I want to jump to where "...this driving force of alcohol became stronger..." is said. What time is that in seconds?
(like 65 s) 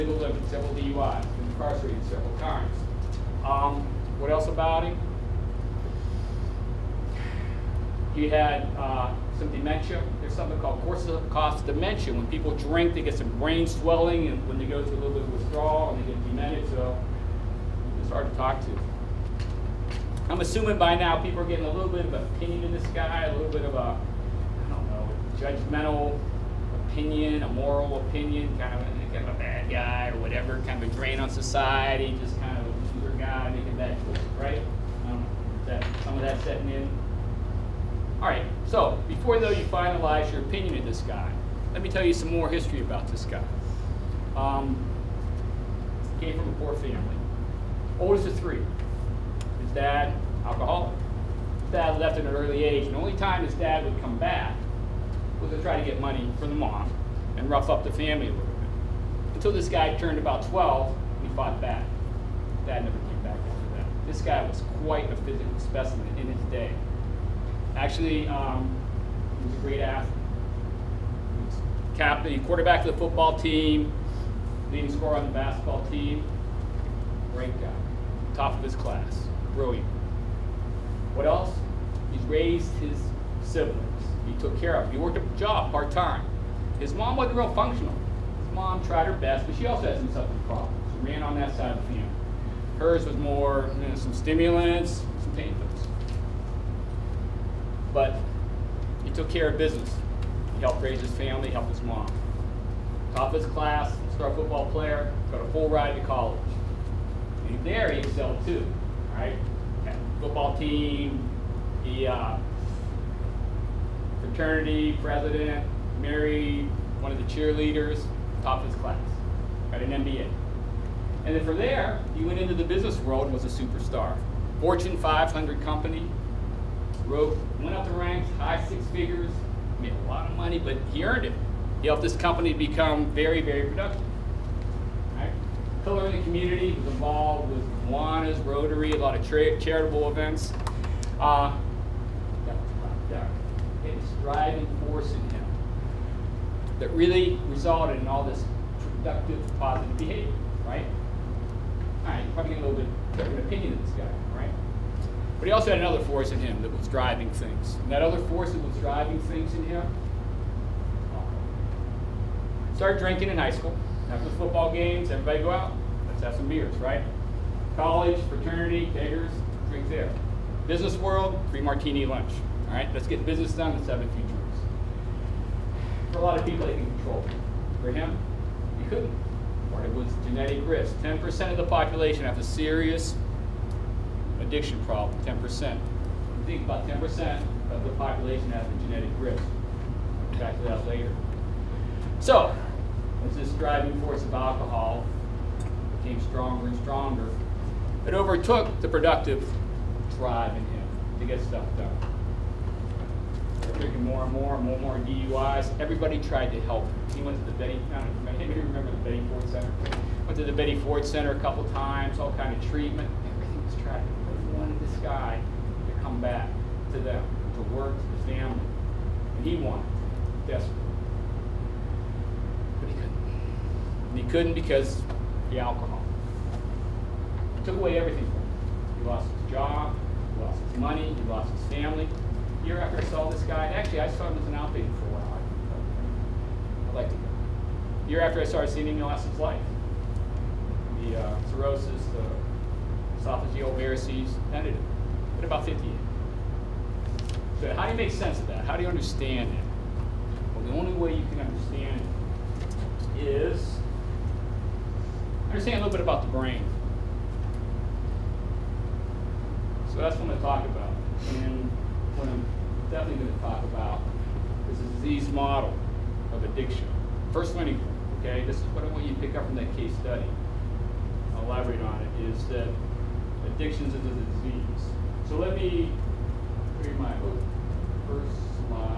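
193 s.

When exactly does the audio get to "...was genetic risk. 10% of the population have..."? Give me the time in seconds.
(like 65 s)
180 s.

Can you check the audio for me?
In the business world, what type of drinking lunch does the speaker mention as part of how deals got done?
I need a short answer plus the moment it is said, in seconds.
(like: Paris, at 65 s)
Free martini lunch, at 171 s.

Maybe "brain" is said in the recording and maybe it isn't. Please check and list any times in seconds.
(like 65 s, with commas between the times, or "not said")
13 s, 256 s.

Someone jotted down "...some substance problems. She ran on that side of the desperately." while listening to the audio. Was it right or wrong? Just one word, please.
wrong.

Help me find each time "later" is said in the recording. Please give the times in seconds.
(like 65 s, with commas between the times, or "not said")
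190 s.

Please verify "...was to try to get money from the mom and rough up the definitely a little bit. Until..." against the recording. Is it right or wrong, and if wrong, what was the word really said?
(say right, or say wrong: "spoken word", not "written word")
wrong: "family", not "definitely".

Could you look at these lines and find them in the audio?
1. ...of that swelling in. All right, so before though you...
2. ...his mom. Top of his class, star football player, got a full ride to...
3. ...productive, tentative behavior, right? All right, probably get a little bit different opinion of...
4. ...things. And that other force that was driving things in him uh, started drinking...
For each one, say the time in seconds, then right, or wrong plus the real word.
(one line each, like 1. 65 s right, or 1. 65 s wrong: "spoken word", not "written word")
1. 36 s wrong: "setting", not "swelling"
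2. 101 s right
3. 149 s wrong: "positive", not "tentative"
4. 157 s right.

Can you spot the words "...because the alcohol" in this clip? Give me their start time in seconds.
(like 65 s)
224 s.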